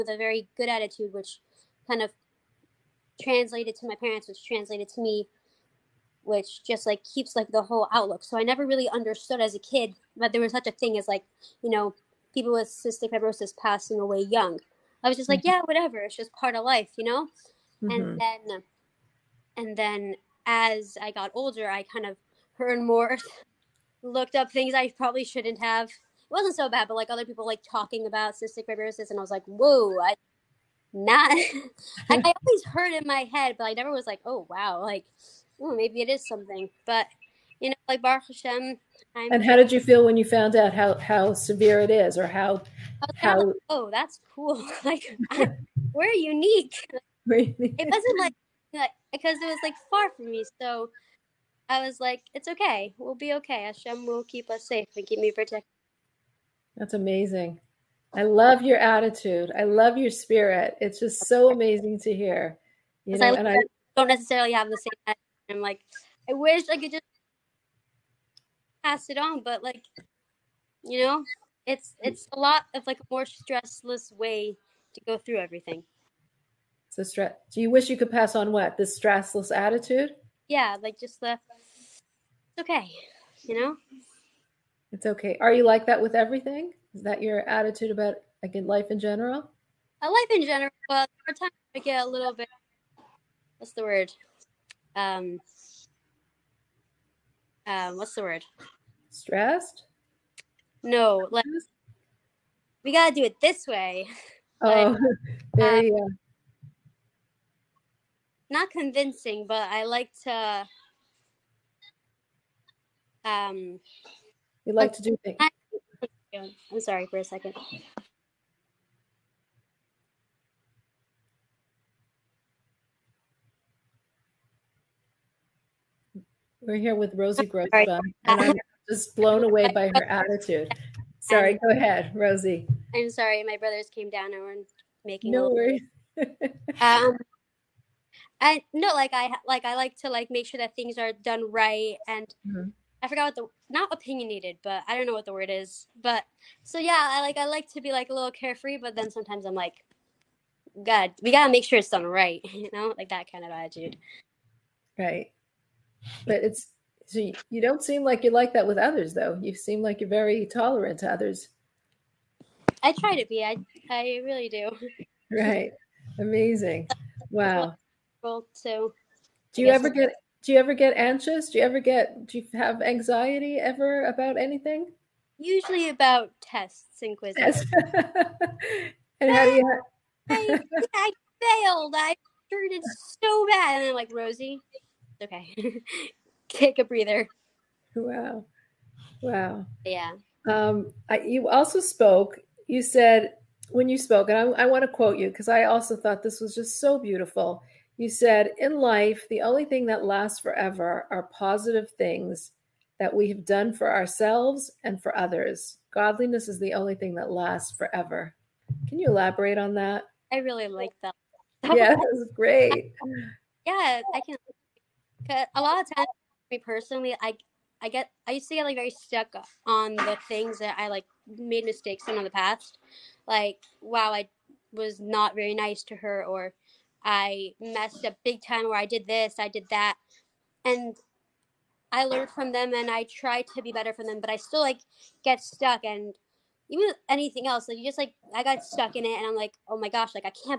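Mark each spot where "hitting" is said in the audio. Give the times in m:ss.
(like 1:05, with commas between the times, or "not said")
not said.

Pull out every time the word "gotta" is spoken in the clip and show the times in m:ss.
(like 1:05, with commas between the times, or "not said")
1:42, 2:31.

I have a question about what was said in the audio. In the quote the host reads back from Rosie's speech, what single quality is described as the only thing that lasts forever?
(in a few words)
Godliness.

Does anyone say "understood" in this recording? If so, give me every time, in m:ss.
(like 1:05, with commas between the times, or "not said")
0:08.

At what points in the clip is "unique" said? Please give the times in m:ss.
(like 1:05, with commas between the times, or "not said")
0:46.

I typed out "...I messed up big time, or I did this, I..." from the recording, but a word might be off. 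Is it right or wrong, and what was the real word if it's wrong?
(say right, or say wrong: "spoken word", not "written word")
right.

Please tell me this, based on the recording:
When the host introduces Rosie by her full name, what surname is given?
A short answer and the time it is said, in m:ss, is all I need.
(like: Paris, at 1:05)
Grossbaum, at 2:07.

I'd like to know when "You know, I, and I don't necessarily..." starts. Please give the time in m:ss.
1:03.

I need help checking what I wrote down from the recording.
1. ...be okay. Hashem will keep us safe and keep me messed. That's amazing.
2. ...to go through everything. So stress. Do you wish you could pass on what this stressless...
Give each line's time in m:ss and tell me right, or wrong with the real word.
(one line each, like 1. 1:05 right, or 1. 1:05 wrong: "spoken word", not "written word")
1. 0:53 wrong: "protected", not "messed"
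2. 1:14 right.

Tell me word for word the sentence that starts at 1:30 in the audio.
I uh, life in general, but sometimes I get a little bit.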